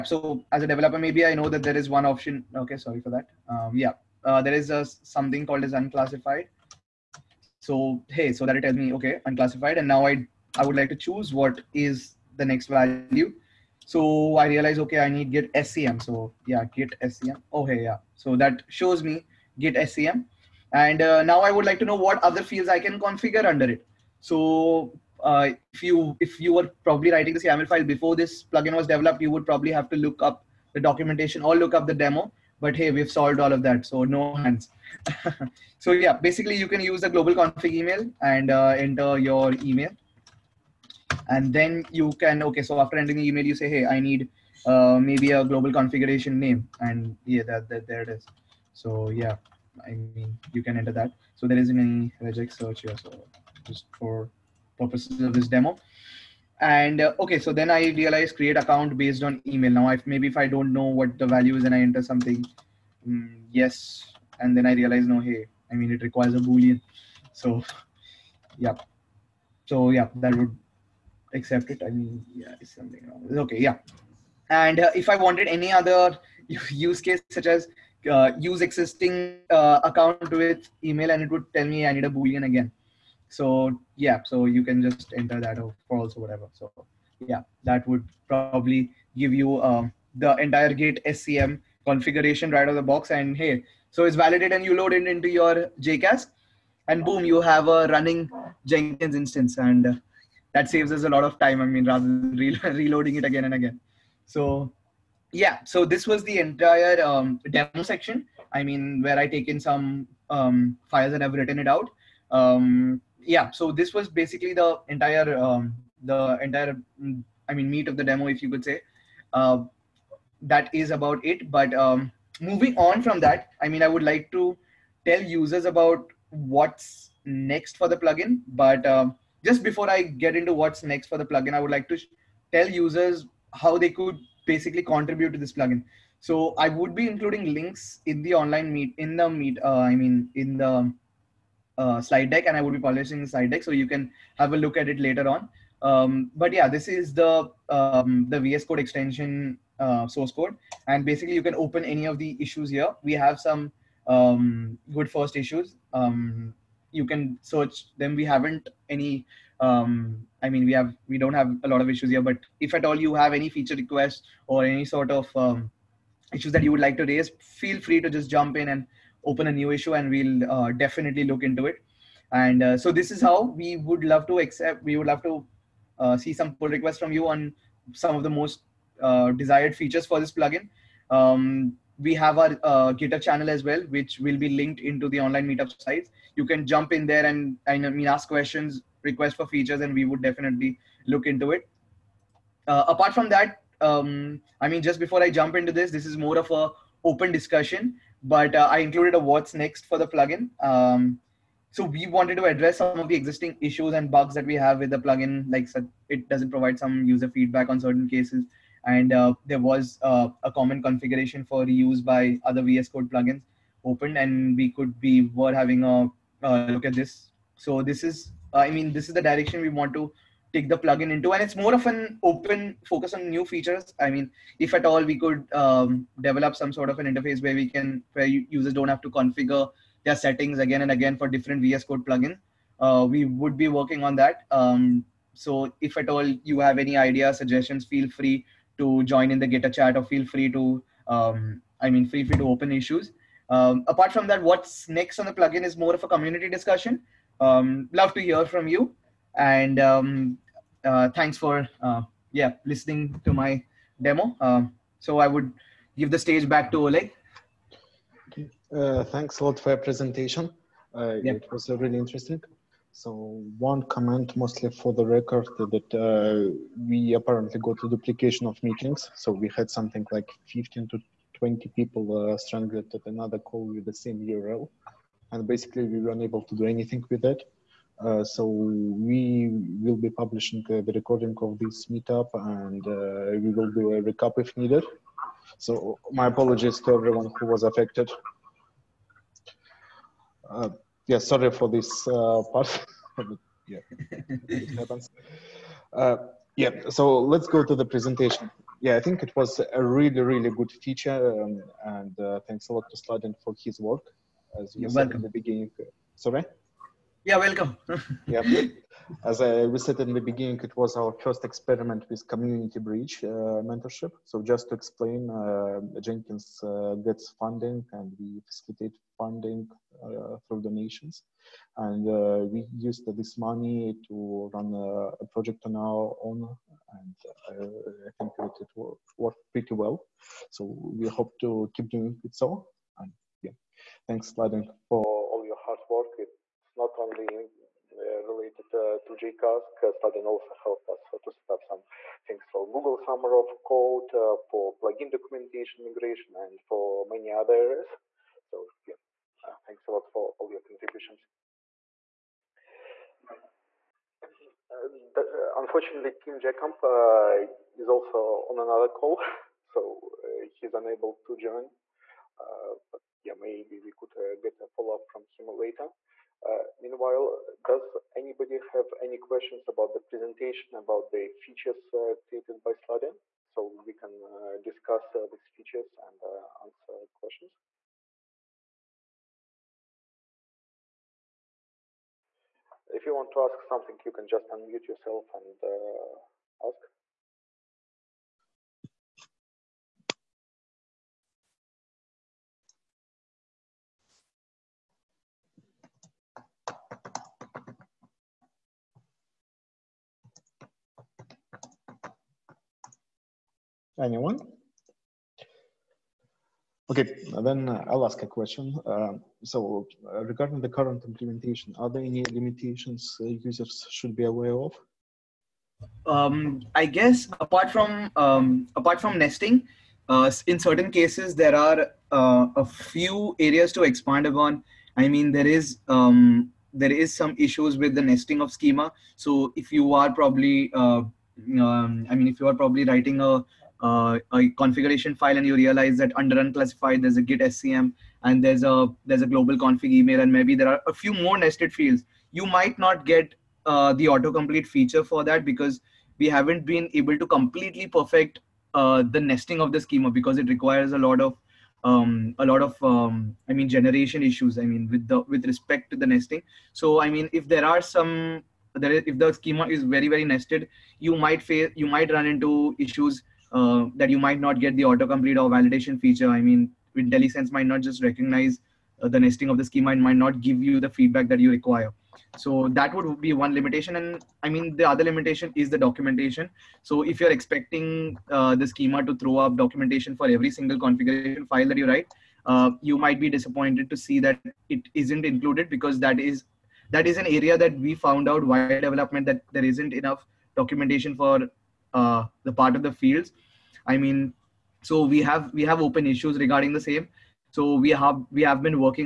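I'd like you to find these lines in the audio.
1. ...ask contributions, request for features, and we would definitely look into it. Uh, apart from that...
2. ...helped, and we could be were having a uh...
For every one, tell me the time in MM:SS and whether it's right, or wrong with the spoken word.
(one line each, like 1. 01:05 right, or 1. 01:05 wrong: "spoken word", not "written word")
1. 03:08 wrong: "questions", not "contributions"
2. 03:33 wrong: "opened", not "helped".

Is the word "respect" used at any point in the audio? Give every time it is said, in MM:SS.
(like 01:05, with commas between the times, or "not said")
07:35.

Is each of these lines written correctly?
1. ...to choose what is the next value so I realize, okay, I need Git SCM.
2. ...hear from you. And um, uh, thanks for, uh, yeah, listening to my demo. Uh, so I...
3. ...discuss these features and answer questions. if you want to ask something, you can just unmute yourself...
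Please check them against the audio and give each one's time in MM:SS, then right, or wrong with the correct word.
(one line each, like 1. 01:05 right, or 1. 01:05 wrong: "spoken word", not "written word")
1. 00:10 right
2. 04:08 right
3. 06:14 right.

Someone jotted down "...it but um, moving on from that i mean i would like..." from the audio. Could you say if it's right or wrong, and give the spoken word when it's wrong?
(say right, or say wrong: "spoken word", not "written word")
right.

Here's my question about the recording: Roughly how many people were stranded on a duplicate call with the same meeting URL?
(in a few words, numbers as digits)
15 to 20.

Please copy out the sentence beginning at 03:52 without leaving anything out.
Uh, we would be working on that.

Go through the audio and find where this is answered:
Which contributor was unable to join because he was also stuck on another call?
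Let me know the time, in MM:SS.
05:56.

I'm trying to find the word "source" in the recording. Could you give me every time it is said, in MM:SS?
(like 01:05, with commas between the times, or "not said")
02:30.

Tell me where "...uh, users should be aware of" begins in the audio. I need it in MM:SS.
06:53.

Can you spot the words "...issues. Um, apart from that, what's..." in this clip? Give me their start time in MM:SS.
04:02.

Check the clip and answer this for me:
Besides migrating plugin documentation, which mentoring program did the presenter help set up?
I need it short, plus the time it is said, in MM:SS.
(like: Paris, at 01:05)
Google Summer of Code, at 05:42.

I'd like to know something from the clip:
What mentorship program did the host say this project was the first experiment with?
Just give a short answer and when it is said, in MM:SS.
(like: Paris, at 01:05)
community bridge, at 05:12.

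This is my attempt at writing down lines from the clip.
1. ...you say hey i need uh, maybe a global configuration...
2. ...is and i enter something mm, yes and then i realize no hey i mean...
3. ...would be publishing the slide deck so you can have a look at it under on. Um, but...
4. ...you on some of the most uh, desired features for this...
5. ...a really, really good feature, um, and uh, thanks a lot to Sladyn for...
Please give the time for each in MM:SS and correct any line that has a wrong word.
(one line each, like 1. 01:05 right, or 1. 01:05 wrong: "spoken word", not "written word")
1. 00:43 right
2. 01:01 right
3. 02:22 wrong: "later", not "under"
4. 02:57 right
5. 04:59 right.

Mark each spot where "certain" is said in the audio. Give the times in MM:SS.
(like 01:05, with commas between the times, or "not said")
03:27, 07:00.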